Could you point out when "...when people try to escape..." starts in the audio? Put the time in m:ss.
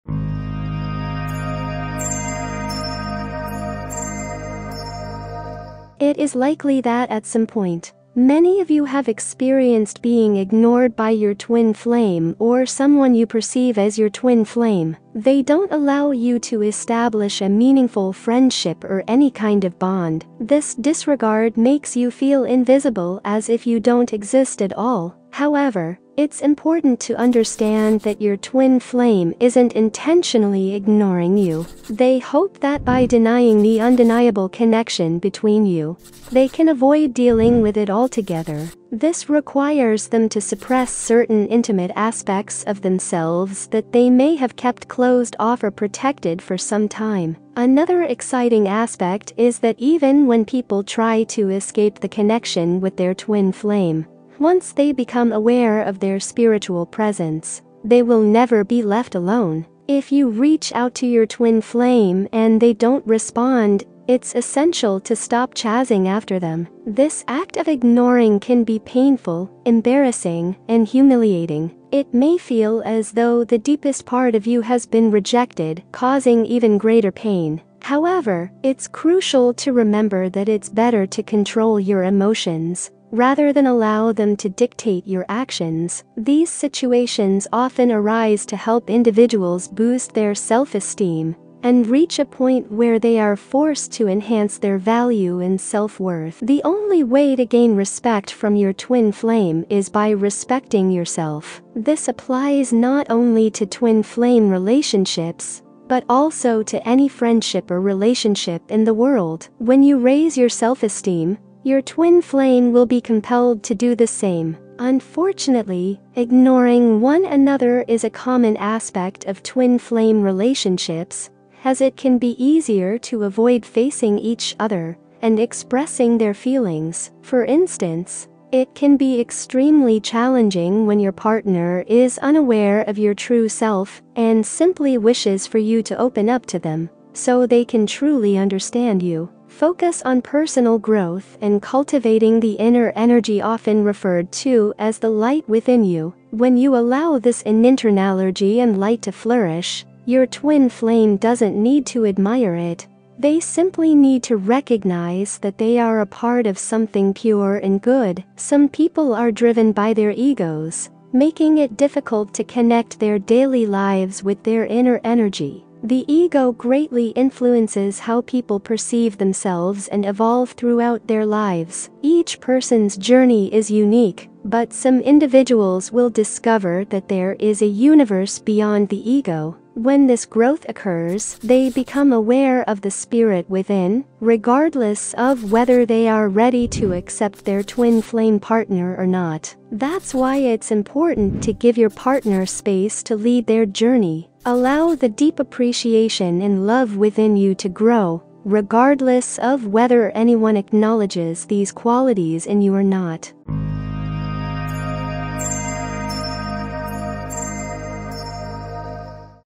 0:50.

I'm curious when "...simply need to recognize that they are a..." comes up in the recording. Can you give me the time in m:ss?
2:33.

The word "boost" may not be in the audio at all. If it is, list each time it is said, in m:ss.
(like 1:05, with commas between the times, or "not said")
1:29.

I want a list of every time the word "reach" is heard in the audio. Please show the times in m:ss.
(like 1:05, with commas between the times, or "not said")
1:00, 1:31.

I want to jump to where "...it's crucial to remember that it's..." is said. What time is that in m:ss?
1:18.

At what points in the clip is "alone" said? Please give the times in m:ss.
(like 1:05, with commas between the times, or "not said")
0:59.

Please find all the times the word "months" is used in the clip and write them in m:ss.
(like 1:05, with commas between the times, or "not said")
not said.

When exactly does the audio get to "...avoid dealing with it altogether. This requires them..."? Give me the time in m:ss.
0:36.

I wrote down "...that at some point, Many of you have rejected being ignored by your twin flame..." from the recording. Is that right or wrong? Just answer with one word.
wrong.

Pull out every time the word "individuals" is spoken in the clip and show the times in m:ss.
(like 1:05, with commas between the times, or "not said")
1:28, 2:54.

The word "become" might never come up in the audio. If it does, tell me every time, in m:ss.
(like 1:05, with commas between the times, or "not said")
0:54, 3:01.